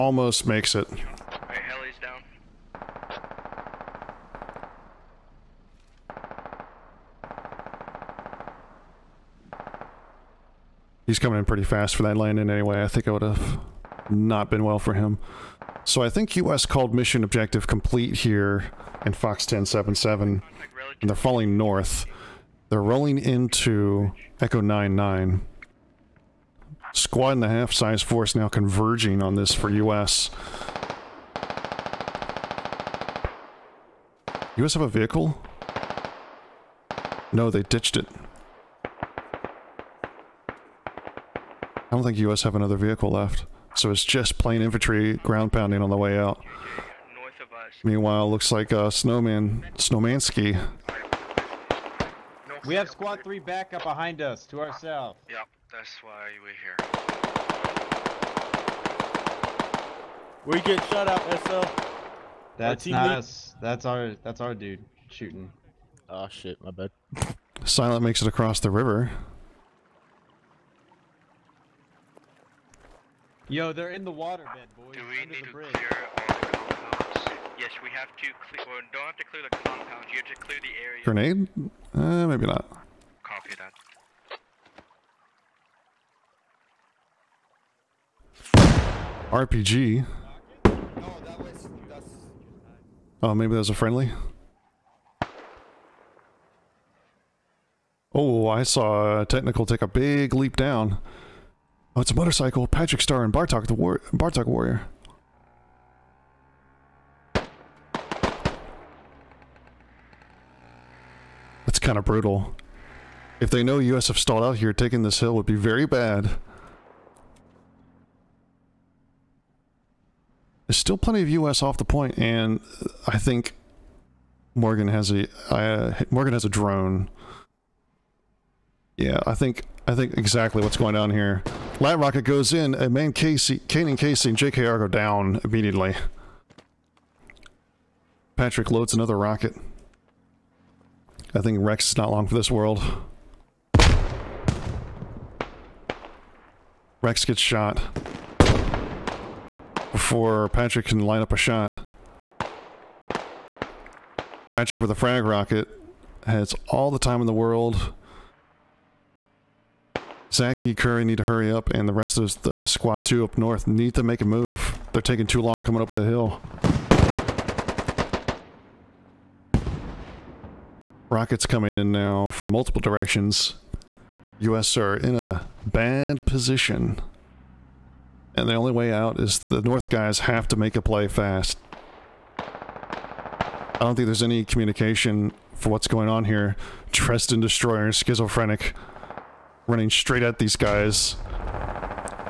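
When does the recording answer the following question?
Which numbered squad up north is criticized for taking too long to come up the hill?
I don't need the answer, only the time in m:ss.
2:42.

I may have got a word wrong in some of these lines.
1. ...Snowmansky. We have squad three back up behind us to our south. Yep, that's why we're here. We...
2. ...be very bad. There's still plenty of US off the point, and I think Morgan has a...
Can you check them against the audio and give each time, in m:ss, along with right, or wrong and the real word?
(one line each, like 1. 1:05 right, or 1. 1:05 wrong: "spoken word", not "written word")
1. 0:49 right
2. 1:55 right.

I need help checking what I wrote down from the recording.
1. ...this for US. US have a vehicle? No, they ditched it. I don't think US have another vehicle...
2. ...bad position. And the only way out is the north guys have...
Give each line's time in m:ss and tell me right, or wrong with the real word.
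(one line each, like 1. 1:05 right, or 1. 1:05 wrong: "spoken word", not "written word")
1. 0:29 right
2. 2:55 right.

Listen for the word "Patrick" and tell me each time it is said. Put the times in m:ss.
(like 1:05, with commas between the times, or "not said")
1:42, 2:18, 2:30, 2:34.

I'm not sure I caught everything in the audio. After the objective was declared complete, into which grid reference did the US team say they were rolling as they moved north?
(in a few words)
Echo 99.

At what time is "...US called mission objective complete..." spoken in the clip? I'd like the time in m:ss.
0:16.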